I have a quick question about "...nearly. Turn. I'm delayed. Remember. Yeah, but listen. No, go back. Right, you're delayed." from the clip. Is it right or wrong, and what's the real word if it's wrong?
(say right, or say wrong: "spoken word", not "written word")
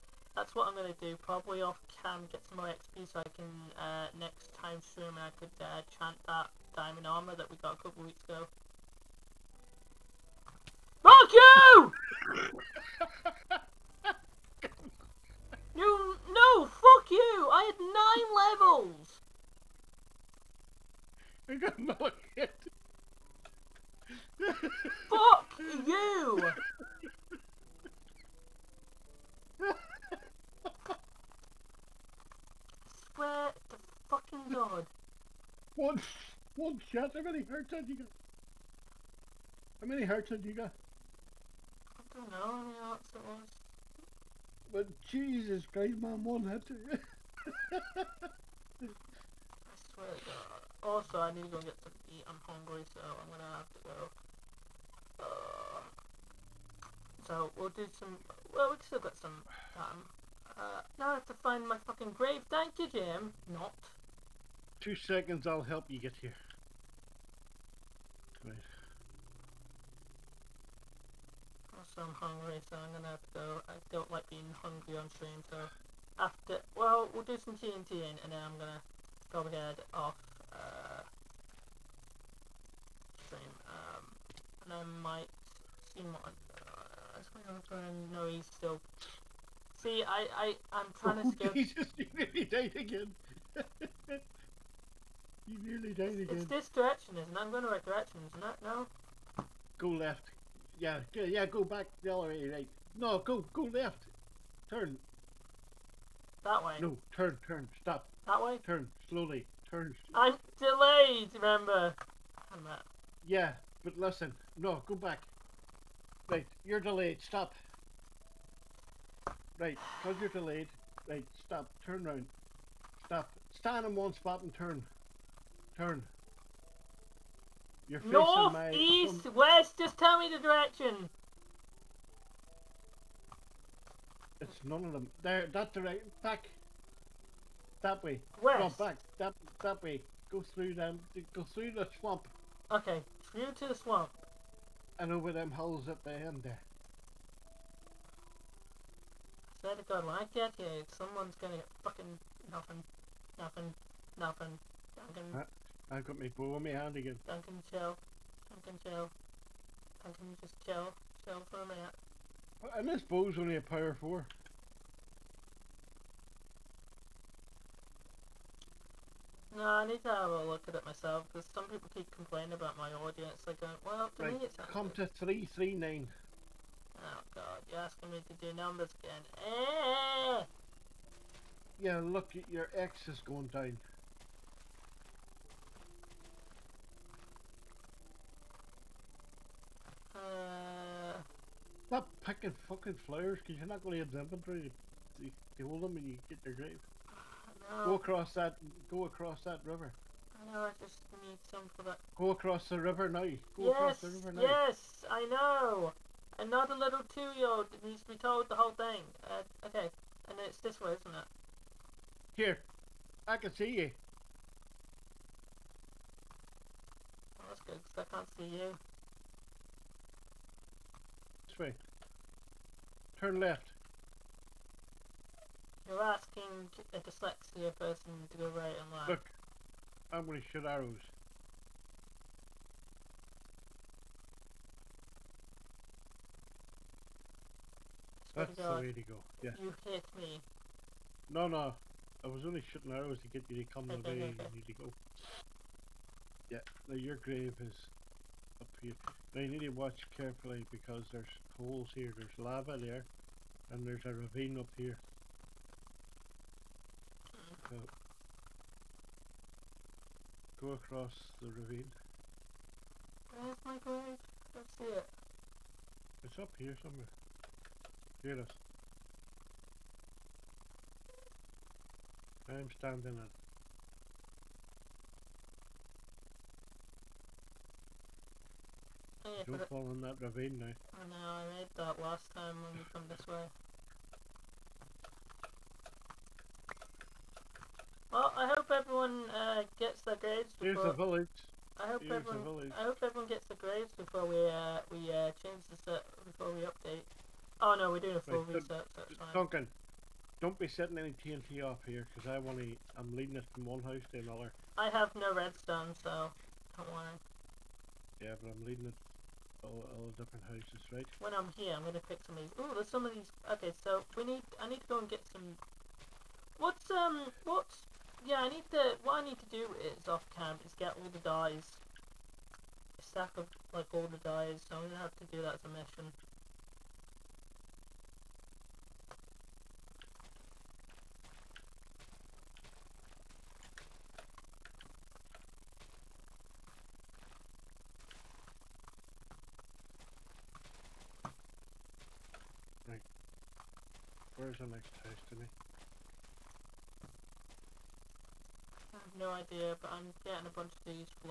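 wrong: "slowly", not "nearly".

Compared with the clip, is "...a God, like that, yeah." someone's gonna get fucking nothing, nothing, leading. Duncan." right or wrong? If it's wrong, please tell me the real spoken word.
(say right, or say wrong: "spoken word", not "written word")
wrong: "nothing", not "leading".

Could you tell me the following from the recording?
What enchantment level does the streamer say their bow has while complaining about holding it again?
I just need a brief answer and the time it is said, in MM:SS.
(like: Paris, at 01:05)
Power 4, at 02:43.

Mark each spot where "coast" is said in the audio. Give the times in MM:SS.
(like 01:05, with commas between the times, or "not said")
not said.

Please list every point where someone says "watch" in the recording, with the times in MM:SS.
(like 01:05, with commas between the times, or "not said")
04:09.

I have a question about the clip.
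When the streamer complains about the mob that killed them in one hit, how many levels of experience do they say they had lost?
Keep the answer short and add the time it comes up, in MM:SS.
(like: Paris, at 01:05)
9, at 00:18.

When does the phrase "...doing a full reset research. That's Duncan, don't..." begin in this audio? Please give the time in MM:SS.
04:57.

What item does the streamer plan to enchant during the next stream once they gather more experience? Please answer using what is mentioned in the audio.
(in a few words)
Diamond armor.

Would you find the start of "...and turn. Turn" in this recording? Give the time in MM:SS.
02:04.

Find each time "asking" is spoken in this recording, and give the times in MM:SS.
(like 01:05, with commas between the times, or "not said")
02:57, 03:46.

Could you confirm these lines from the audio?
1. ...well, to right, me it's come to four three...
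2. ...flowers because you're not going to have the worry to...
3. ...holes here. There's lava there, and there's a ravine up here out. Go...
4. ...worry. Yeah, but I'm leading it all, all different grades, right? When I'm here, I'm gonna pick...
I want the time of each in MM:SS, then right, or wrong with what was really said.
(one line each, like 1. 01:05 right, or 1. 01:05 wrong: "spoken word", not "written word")
1. 02:53 wrong: "three", not "four"
2. 03:13 wrong: "inventory", not "worry"
3. 04:11 right
4. 05:06 wrong: "houses", not "grades".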